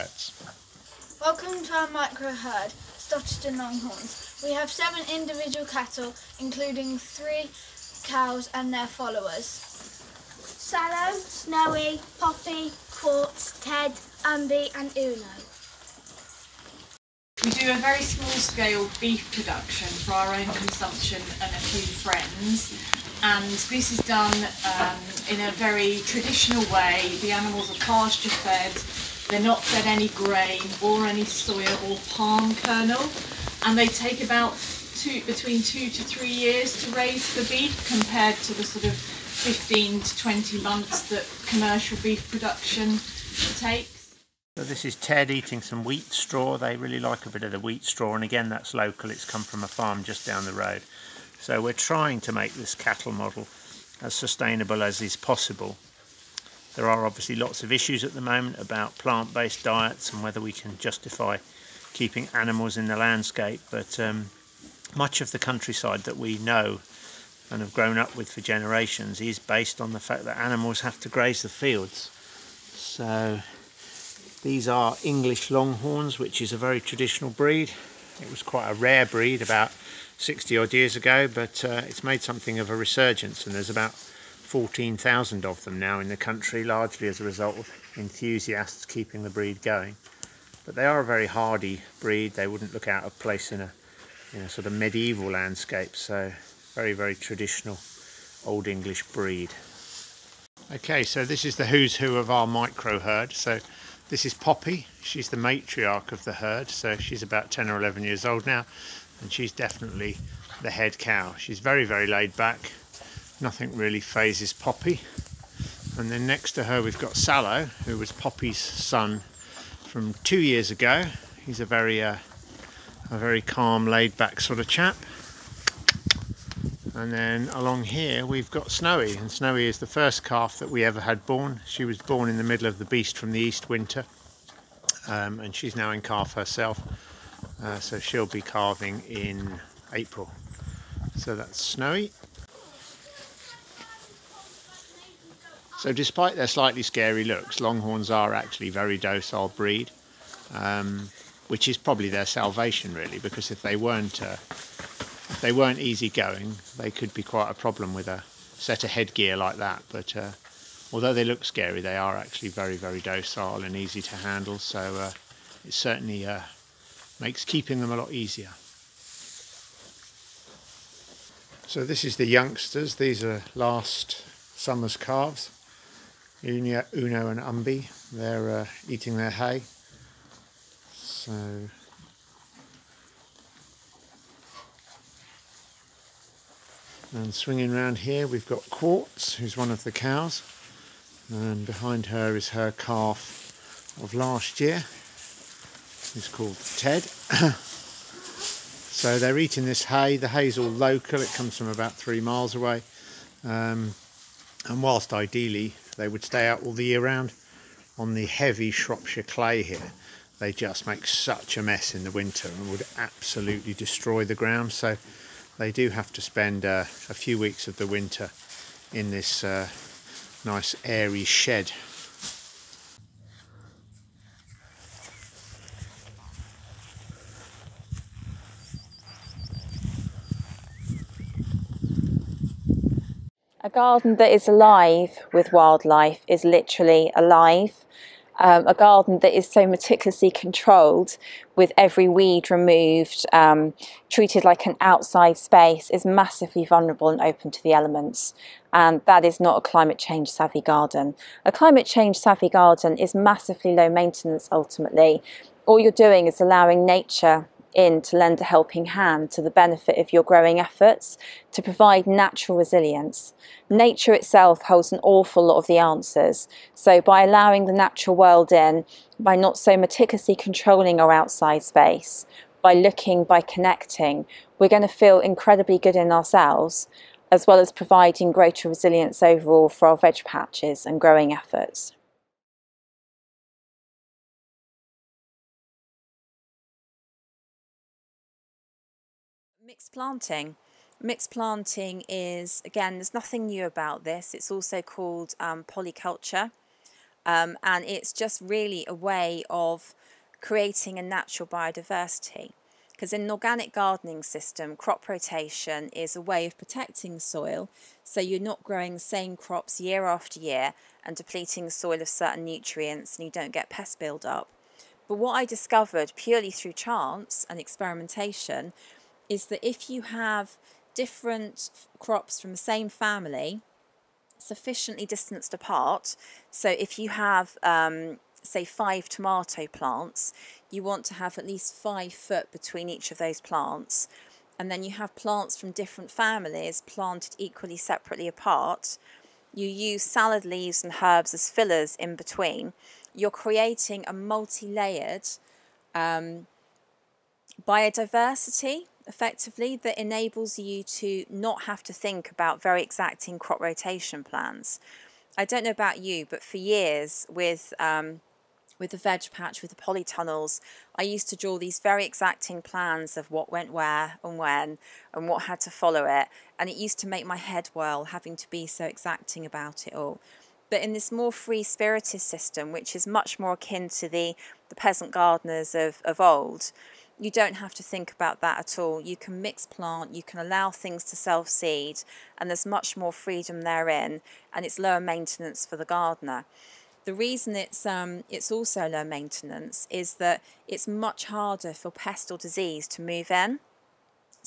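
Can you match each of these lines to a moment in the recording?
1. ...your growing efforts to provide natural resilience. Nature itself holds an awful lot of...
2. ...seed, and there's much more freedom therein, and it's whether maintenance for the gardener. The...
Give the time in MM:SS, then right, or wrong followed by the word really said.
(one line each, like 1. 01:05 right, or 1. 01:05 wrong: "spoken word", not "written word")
1. 04:20 right
2. 06:21 wrong: "lower", not "whether".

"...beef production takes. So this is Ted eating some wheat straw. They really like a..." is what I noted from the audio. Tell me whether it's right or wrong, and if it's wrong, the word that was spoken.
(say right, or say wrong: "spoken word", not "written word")
right.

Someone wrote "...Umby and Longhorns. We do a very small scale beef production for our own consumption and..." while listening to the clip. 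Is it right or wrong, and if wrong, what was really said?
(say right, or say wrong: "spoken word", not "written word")
wrong: "Uno", not "Longhorns".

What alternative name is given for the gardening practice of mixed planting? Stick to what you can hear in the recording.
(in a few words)
polyculture.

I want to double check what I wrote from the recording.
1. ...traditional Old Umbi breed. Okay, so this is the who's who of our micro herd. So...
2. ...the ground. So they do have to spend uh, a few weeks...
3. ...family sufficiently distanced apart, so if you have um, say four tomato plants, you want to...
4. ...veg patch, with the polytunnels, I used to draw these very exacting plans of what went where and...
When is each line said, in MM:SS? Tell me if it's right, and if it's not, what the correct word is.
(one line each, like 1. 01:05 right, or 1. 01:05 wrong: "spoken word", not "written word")
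1. 01:37 wrong: "English", not "Umbi"
2. 03:34 right
3. 05:22 wrong: "five", not "four"
4. 05:58 right.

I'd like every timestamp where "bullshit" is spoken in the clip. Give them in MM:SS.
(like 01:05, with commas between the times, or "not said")
not said.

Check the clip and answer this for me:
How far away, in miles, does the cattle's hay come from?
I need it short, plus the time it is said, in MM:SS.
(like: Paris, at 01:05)
3 miles, at 03:21.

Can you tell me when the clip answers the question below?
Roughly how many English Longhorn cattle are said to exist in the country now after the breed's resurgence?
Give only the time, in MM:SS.
01:23.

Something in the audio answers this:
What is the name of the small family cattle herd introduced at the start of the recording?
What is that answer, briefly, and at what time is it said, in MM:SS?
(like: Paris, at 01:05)
Stotterton Longhorns, at 00:02.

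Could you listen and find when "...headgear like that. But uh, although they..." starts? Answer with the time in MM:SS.
02:38.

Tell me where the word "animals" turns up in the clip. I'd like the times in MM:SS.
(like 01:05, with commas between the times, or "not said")
00:27, 01:02, 01:10.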